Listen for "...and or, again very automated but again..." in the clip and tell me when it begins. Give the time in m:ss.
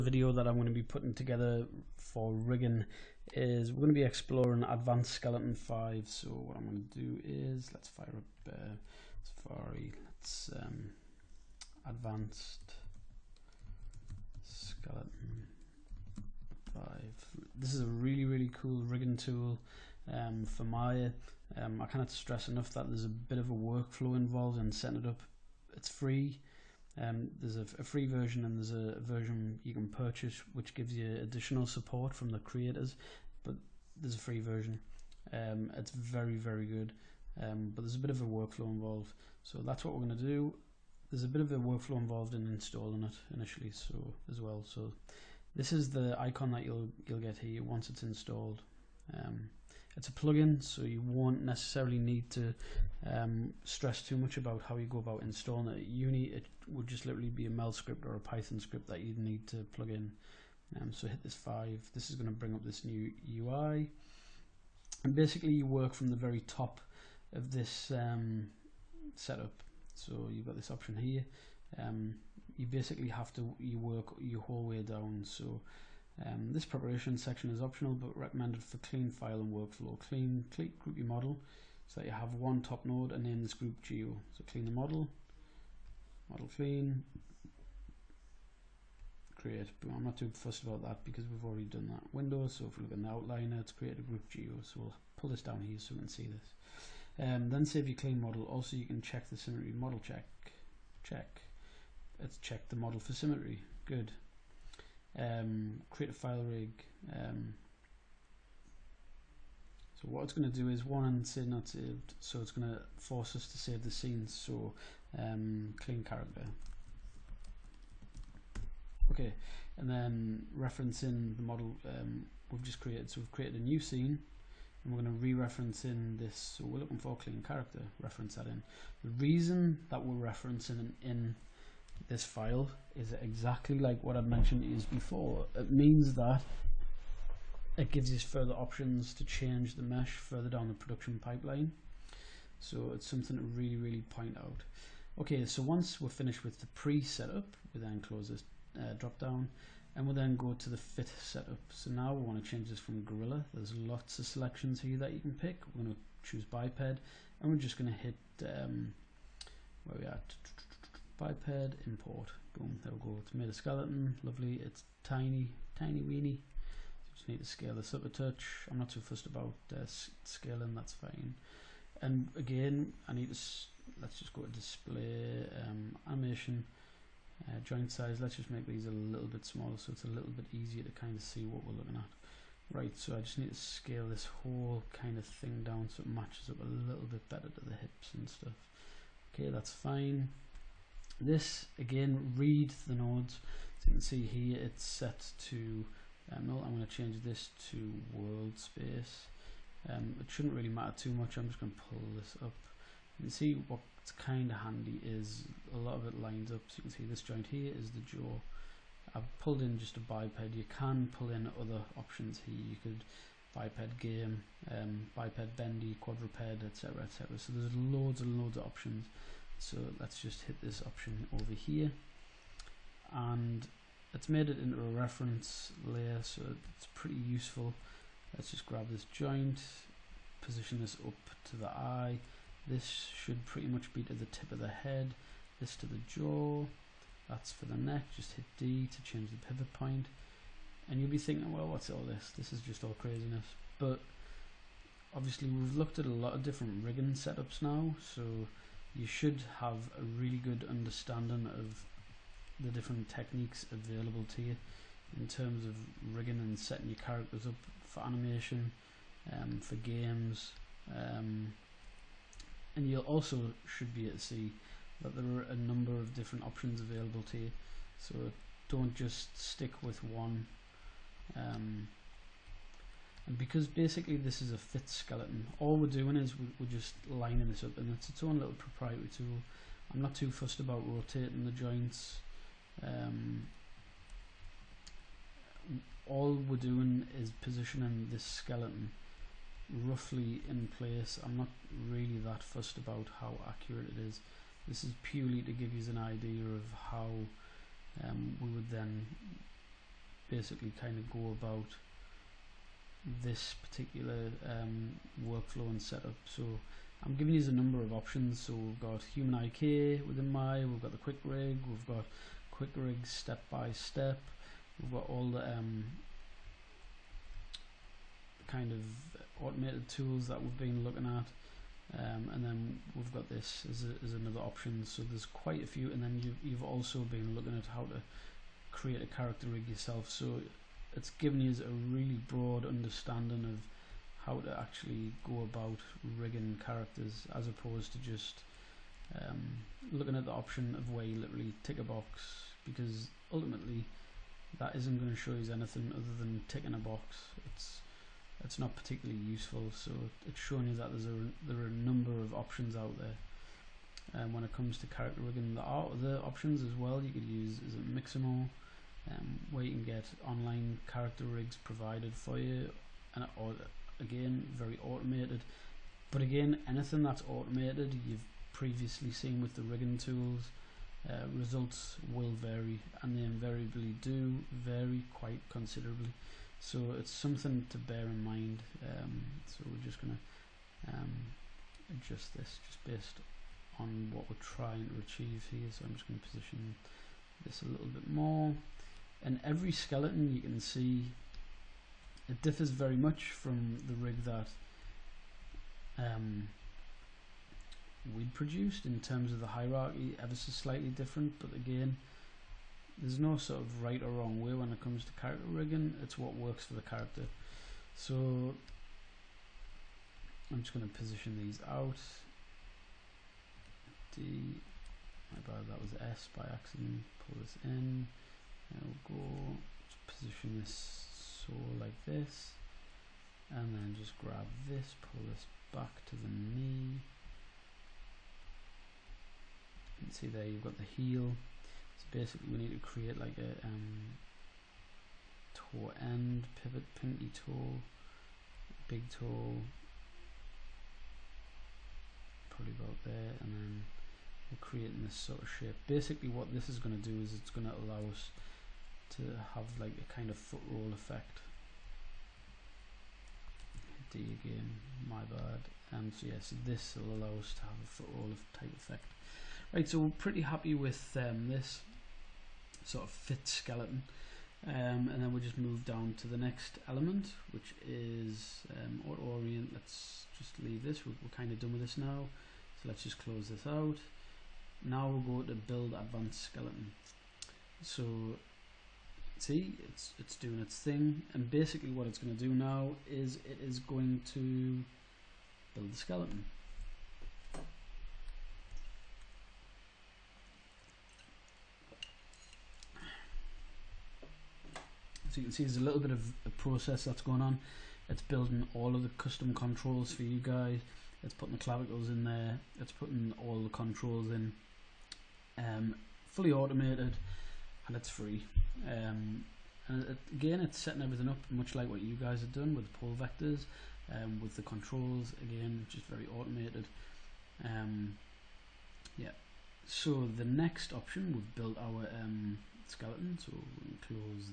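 6:03.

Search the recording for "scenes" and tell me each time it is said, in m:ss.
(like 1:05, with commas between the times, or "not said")
1:53, 2:03.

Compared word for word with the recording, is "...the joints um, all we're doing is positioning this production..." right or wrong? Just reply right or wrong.
wrong.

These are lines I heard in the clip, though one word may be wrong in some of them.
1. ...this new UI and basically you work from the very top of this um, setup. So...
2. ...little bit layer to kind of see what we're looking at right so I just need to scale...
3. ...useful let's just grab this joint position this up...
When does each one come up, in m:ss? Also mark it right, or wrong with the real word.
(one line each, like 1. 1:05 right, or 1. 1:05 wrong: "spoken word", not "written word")
1. 1:02 right
2. 3:00 wrong: "easier", not "layer"
3. 3:47 right.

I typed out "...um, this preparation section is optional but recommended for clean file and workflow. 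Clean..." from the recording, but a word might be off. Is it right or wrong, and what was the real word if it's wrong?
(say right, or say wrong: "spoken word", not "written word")
right.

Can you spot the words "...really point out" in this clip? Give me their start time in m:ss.
2:23.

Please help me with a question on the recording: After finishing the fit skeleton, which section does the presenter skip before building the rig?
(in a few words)
auto orient.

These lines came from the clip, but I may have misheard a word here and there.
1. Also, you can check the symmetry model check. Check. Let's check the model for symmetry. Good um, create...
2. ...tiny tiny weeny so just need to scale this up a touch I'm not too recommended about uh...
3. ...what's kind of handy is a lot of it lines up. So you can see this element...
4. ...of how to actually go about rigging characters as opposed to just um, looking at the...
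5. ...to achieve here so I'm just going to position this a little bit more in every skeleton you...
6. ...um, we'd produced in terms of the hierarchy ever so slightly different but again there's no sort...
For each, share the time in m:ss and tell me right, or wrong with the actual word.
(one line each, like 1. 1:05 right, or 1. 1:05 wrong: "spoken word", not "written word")
1. 1:38 right
2. 2:45 wrong: "fussed", not "recommended"
3. 3:23 wrong: "joint", not "element"
4. 5:33 right
5. 6:24 right
6. 6:35 right.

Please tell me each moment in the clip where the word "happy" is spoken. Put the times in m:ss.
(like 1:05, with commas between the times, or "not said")
7:40.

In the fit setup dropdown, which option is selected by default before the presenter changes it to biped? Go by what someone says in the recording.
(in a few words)
Gorilla.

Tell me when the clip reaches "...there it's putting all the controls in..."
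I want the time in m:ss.
8:22.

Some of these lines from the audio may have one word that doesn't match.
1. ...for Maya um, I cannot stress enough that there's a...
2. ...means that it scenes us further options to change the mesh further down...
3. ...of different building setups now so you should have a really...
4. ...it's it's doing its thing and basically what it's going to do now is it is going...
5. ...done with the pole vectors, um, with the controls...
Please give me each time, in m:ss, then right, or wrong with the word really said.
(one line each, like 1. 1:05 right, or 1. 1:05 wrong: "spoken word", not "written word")
1. 0:20 right
2. 2:15 wrong: "gives", not "scenes"
3. 4:06 wrong: "rigging", not "building"
4. 7:59 right
5. 8:32 right.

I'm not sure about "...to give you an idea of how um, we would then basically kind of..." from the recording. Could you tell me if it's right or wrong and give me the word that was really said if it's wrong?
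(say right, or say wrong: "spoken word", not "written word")
right.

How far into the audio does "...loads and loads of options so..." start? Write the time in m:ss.
3:37.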